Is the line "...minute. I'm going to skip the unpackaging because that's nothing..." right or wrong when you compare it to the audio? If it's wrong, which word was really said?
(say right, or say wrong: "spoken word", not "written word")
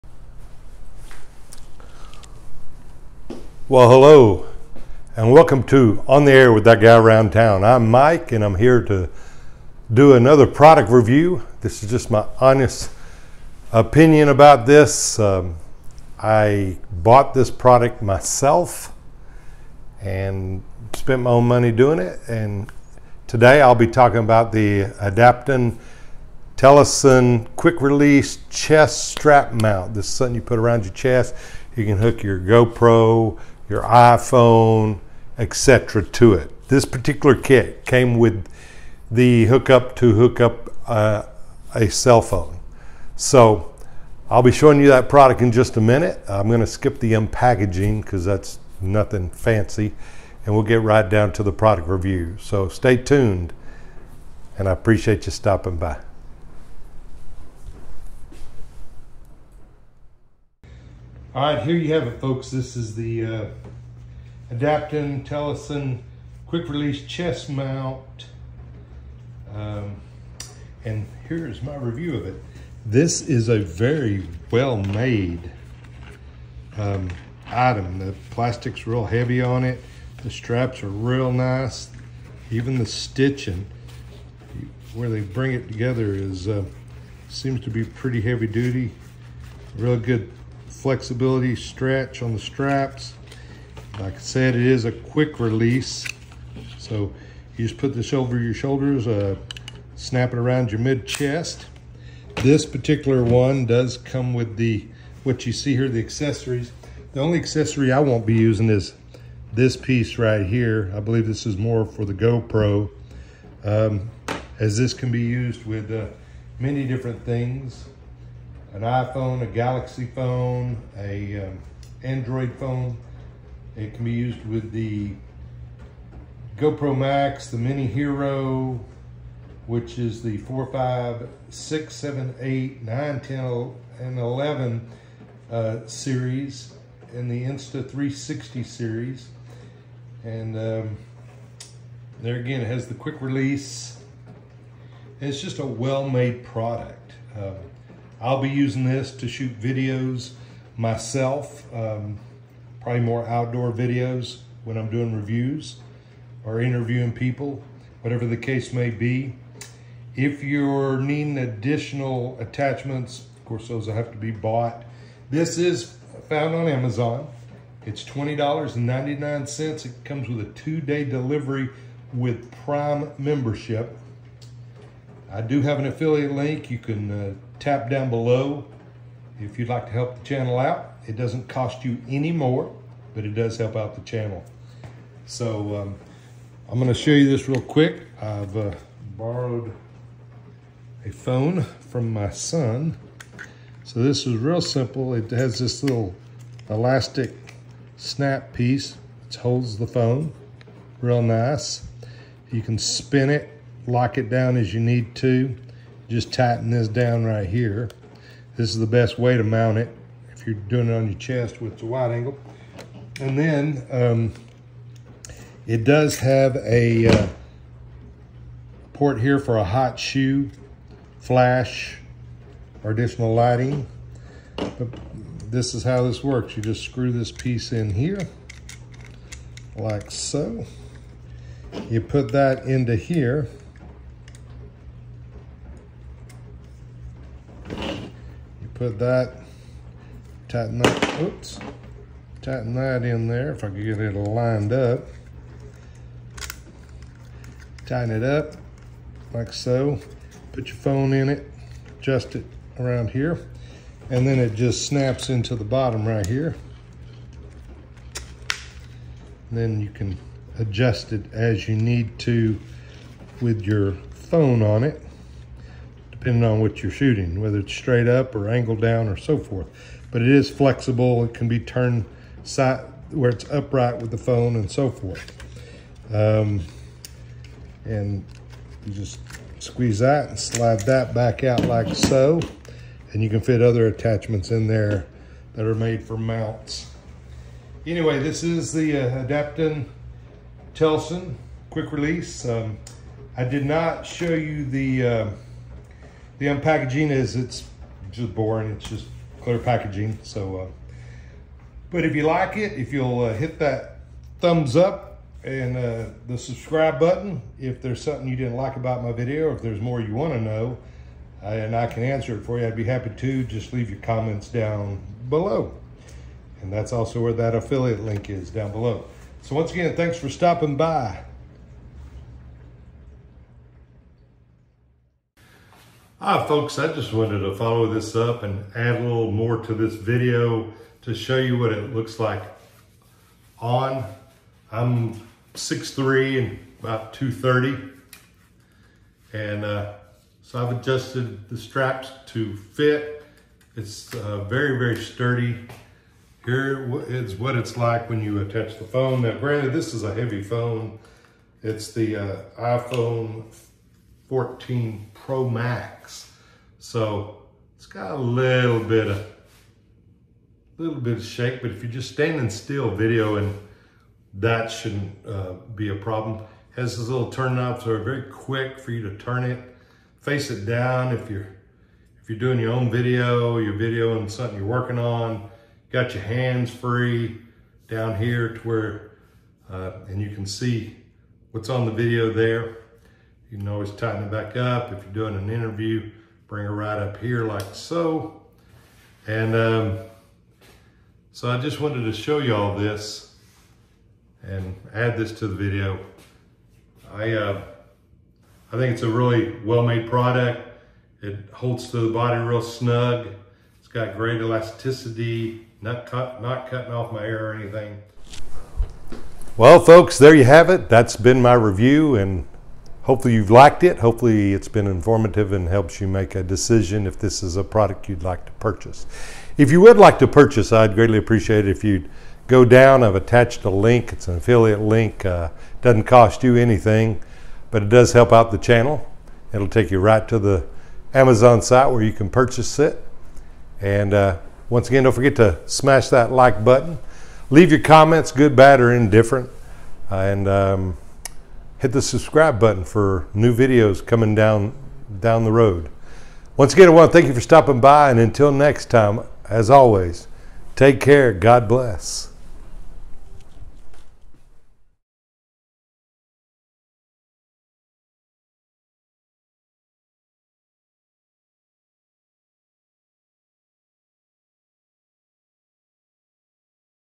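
right.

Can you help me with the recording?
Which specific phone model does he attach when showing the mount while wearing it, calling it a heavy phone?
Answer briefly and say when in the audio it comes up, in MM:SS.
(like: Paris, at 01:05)
iPhone 14 Pro Max, at 05:52.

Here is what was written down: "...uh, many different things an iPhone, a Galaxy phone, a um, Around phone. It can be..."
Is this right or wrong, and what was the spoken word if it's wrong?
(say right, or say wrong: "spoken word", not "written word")
wrong: "Android", not "Around".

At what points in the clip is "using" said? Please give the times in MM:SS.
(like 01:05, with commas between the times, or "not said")
01:48, 02:28.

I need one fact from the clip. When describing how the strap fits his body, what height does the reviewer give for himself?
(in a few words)
6'3.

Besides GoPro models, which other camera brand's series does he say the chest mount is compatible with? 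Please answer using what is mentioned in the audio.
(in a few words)
Insta360.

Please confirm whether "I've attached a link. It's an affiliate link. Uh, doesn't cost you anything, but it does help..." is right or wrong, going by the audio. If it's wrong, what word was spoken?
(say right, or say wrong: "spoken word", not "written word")
right.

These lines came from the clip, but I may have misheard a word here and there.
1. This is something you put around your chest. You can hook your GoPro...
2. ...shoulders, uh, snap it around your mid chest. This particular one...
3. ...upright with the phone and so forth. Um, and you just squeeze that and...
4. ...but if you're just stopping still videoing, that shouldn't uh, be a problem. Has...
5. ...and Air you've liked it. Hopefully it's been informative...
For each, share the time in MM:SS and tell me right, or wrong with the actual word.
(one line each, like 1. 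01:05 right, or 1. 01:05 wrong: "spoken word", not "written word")
1. 00:29 right
2. 01:38 right
3. 04:33 right
4. 06:01 wrong: "standing", not "stopping"
5. 06:52 wrong: "Hopefully", not "Air".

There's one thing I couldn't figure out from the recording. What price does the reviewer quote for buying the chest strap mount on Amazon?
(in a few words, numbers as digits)
$20.99.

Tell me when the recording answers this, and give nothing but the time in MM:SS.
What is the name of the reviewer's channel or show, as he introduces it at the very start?
00:06.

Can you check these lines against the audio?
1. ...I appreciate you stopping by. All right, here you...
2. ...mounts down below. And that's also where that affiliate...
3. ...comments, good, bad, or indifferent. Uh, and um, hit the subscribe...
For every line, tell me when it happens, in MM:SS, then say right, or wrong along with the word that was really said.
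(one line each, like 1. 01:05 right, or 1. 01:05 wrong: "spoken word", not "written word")
1. 00:54 right
2. 05:13 wrong: "comments", not "mounts"
3. 07:17 right.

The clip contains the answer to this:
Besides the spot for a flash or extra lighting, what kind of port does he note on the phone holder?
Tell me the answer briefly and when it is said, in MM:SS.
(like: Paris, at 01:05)
hot shoe, at 03:39.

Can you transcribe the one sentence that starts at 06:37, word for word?
I, uh, I think it's a really well-made product.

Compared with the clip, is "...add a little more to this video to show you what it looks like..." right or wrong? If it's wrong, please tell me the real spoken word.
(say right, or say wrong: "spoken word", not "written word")
right.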